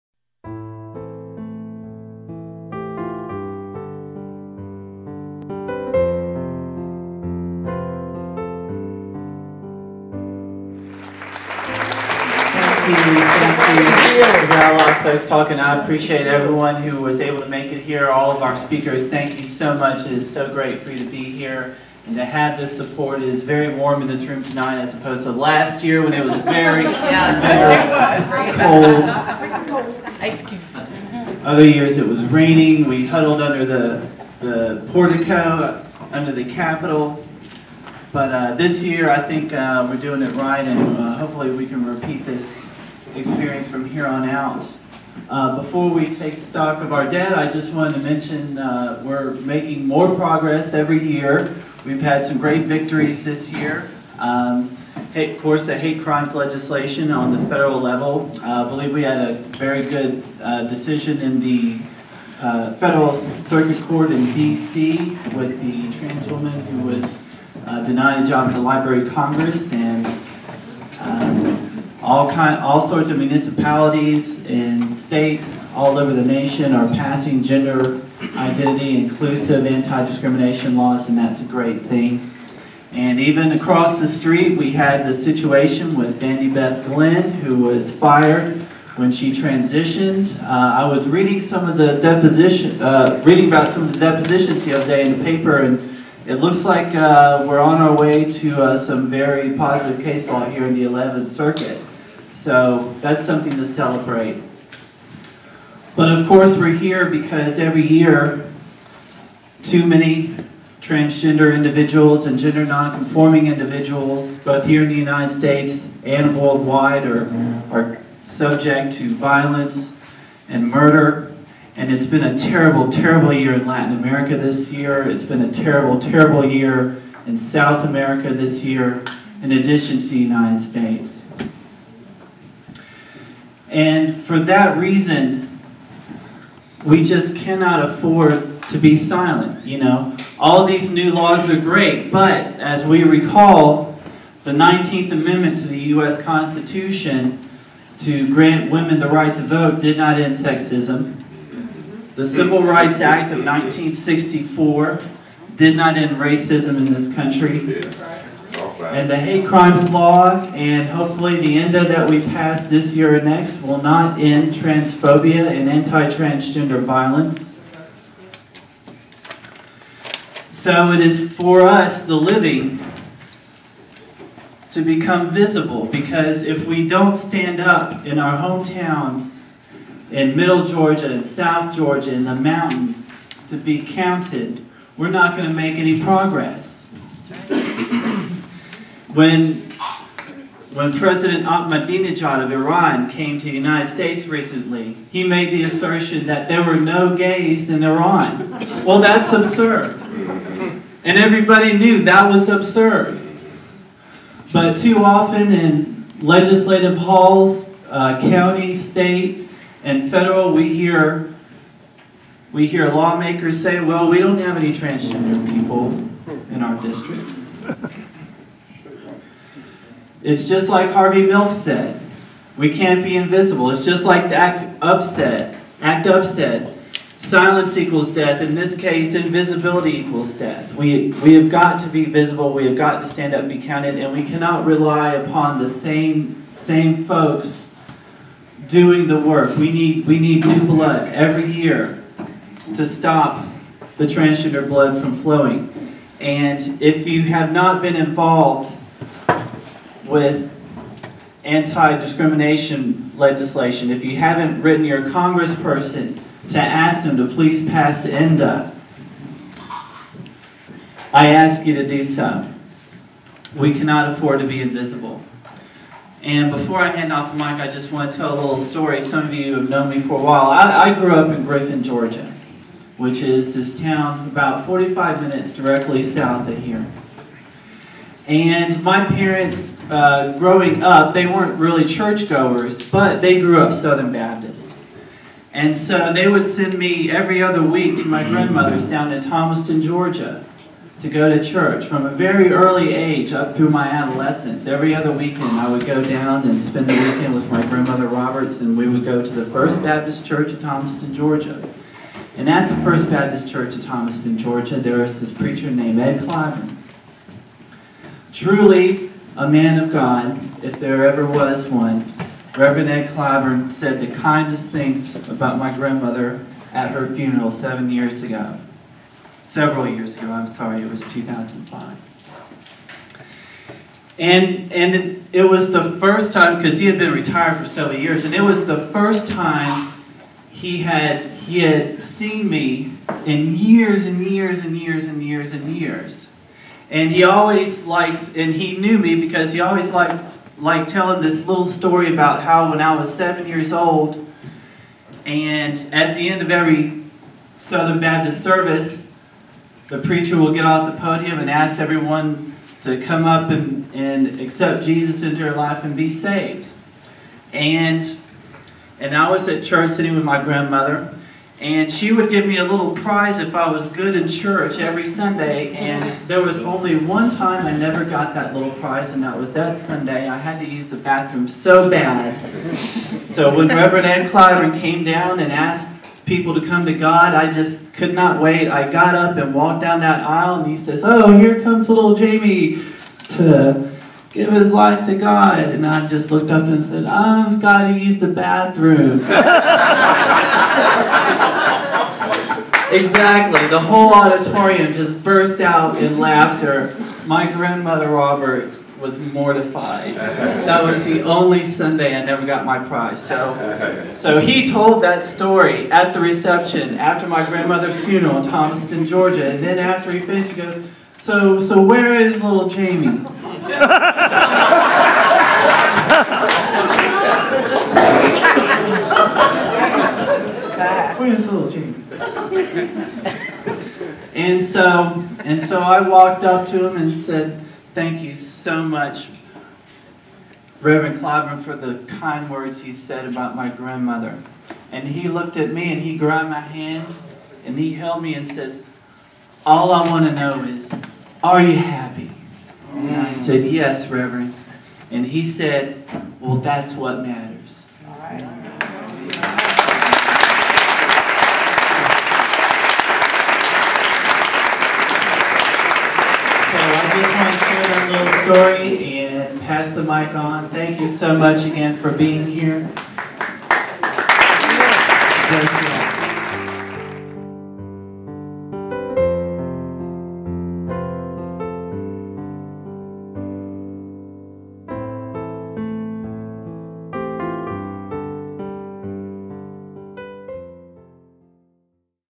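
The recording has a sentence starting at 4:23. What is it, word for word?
We cannot afford to be invisible.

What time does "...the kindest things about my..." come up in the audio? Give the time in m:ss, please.
5:14.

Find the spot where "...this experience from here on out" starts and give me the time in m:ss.
0:42.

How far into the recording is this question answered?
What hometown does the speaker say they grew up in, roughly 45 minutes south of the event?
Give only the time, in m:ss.
4:31.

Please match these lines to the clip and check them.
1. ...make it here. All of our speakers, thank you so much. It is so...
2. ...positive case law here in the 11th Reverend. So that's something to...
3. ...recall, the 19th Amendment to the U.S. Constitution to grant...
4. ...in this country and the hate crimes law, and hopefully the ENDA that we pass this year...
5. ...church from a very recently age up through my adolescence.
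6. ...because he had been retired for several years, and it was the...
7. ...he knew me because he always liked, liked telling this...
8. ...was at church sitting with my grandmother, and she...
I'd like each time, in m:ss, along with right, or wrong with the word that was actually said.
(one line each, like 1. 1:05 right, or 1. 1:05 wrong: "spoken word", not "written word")
1. 0:17 right
2. 1:39 wrong: "Circuit", not "Reverend"
3. 2:23 right
4. 2:36 right
5. 4:51 wrong: "early", not "recently"
6. 5:26 right
7. 5:38 right
8. 5:59 right.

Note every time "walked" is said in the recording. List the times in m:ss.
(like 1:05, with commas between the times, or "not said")
6:19, 7:06.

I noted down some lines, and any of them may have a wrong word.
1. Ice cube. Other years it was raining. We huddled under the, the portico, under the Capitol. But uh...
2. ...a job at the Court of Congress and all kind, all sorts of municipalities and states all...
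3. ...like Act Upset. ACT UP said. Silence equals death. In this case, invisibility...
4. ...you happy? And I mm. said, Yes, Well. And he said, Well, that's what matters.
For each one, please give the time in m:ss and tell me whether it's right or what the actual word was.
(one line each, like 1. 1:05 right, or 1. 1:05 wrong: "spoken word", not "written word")
1. 0:30 right
2. 1:08 wrong: "Library", not "Court"
3. 3:44 right
4. 7:21 wrong: "Reverend", not "Well".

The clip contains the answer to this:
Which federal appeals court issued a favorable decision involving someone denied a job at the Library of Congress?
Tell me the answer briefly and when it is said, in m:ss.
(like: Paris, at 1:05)
Federal Circuit Court in D.C., at 1:02.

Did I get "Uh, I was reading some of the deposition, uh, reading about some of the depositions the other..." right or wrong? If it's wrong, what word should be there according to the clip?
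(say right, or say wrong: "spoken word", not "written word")
right.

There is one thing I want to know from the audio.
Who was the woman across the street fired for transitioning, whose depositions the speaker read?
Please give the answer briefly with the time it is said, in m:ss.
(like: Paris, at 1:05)
Vandy Beth Glenn, at 1:26.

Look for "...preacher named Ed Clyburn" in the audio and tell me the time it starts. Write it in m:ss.
5:05.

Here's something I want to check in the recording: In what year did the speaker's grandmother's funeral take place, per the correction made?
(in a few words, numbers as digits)
2005.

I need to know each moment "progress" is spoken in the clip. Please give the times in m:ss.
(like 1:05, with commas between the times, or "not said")
0:50, 3:06.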